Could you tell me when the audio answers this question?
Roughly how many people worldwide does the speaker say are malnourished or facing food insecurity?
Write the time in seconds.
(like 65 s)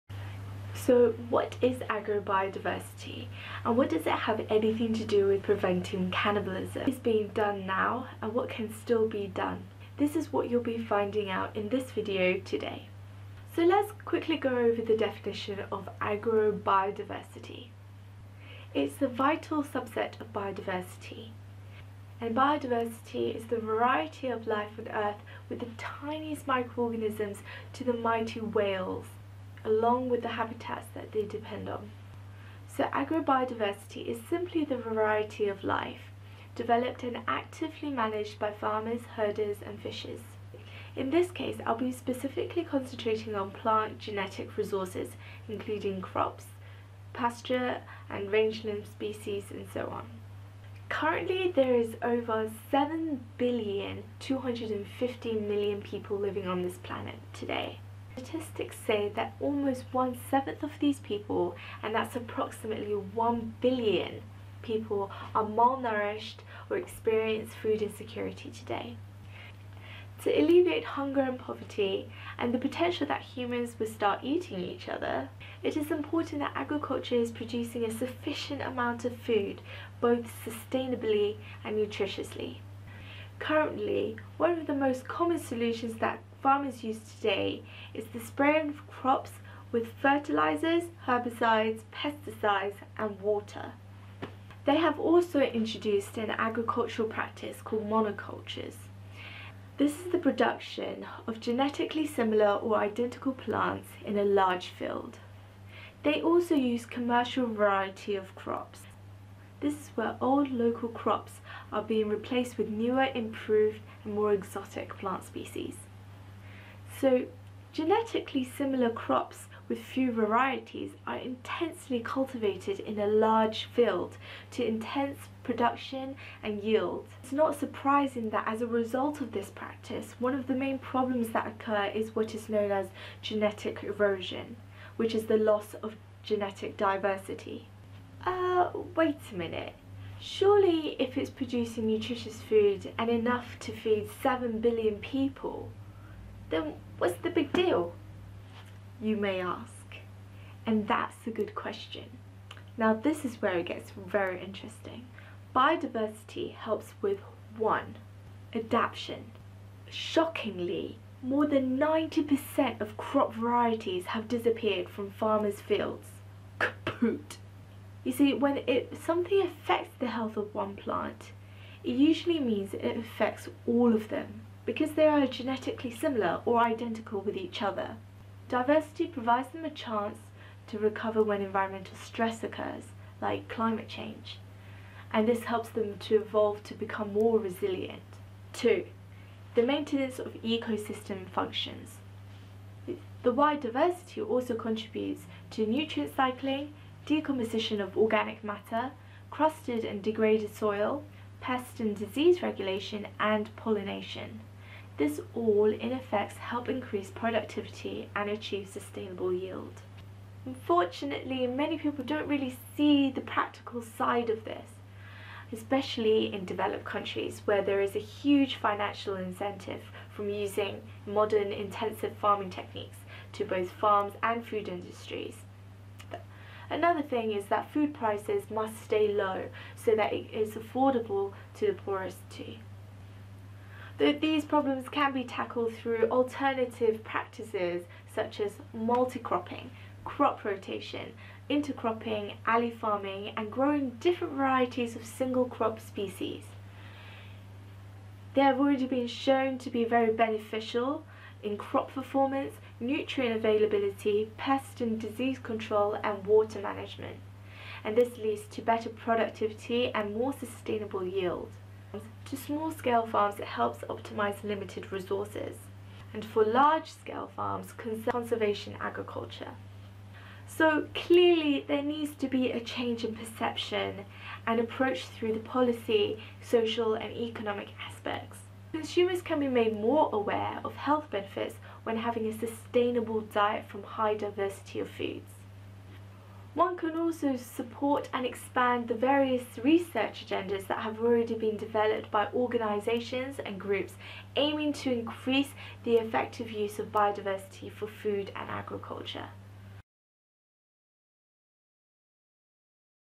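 62 s.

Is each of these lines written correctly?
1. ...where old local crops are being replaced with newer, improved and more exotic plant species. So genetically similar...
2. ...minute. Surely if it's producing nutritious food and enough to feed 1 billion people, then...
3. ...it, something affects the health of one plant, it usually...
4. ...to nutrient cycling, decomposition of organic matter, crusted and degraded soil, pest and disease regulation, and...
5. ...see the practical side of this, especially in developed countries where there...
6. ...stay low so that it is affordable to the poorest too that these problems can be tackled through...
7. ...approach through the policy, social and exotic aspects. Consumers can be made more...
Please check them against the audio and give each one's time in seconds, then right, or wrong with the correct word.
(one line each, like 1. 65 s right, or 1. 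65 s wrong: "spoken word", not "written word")
1. 109 s right
2. 139 s wrong: "7", not "1"
3. 168 s right
4. 195 s right
5. 212 s right
6. 228 s right
7. 274 s wrong: "economic", not "exotic".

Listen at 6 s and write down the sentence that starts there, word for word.
What is being done now and what can still be done?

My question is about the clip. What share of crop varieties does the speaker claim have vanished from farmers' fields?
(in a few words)
more than 90%.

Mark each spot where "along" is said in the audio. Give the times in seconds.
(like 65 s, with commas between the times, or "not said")
29 s.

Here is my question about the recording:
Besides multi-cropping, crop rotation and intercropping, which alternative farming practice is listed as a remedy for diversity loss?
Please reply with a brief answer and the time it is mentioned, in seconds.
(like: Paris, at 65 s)
alley farming, at 242 s.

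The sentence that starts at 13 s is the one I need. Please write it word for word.
So let's quickly go over the definition of agrobiodiversity.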